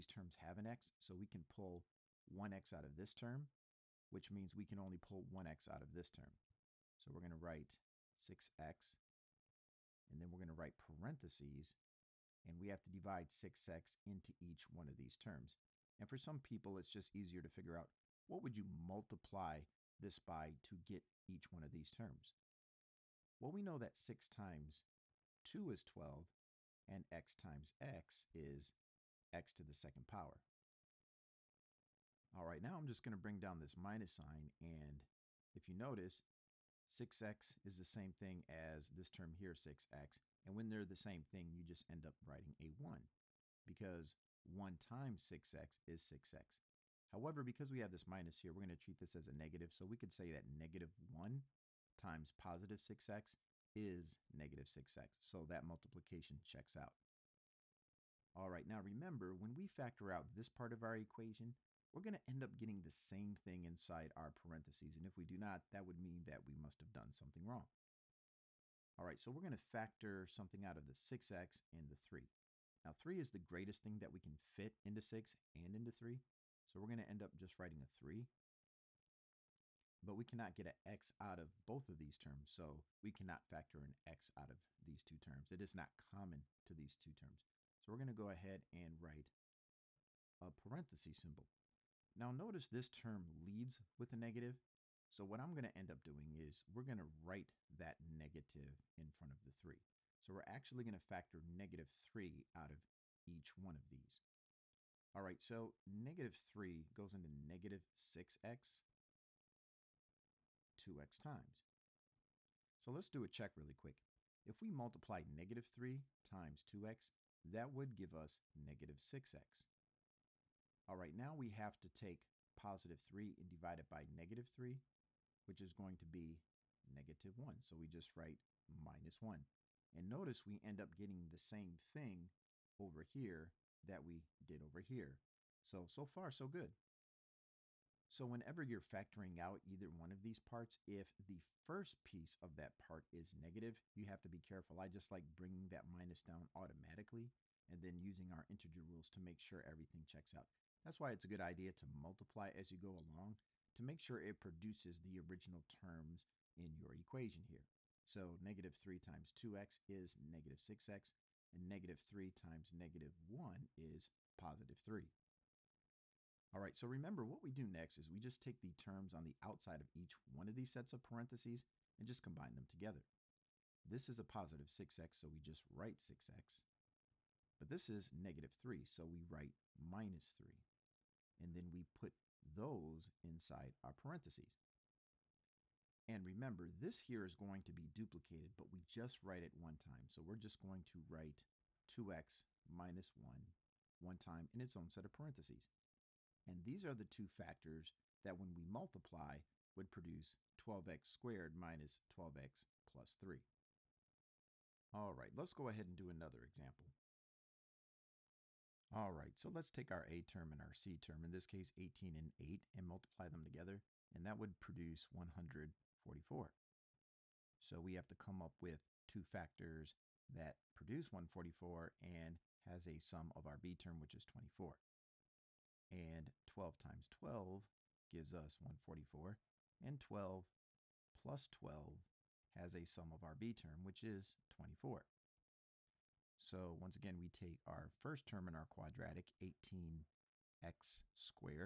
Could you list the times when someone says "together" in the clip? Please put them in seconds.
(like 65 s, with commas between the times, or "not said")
172 s, 213 s.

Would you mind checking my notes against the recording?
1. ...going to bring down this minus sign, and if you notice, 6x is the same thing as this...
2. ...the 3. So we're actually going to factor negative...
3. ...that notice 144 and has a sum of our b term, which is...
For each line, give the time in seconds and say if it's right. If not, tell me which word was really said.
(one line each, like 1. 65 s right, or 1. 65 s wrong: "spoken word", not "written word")
1. 33 s right
2. 99 s right
3. 220 s wrong: "produce", not "notice".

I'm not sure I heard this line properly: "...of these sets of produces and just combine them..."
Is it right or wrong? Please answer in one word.
wrong.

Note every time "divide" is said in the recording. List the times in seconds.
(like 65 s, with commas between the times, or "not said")
12 s, 123 s.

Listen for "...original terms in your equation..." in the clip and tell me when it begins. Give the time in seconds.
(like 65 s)
155 s.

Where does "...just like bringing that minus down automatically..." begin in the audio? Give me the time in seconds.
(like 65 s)
144 s.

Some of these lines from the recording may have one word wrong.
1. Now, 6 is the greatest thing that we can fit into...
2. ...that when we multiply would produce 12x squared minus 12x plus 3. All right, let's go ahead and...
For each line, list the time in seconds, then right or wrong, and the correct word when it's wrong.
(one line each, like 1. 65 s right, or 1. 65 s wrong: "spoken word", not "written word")
1. 72 s wrong: "3", not "6"
2. 198 s right.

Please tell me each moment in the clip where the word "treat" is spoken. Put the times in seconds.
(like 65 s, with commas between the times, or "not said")
48 s.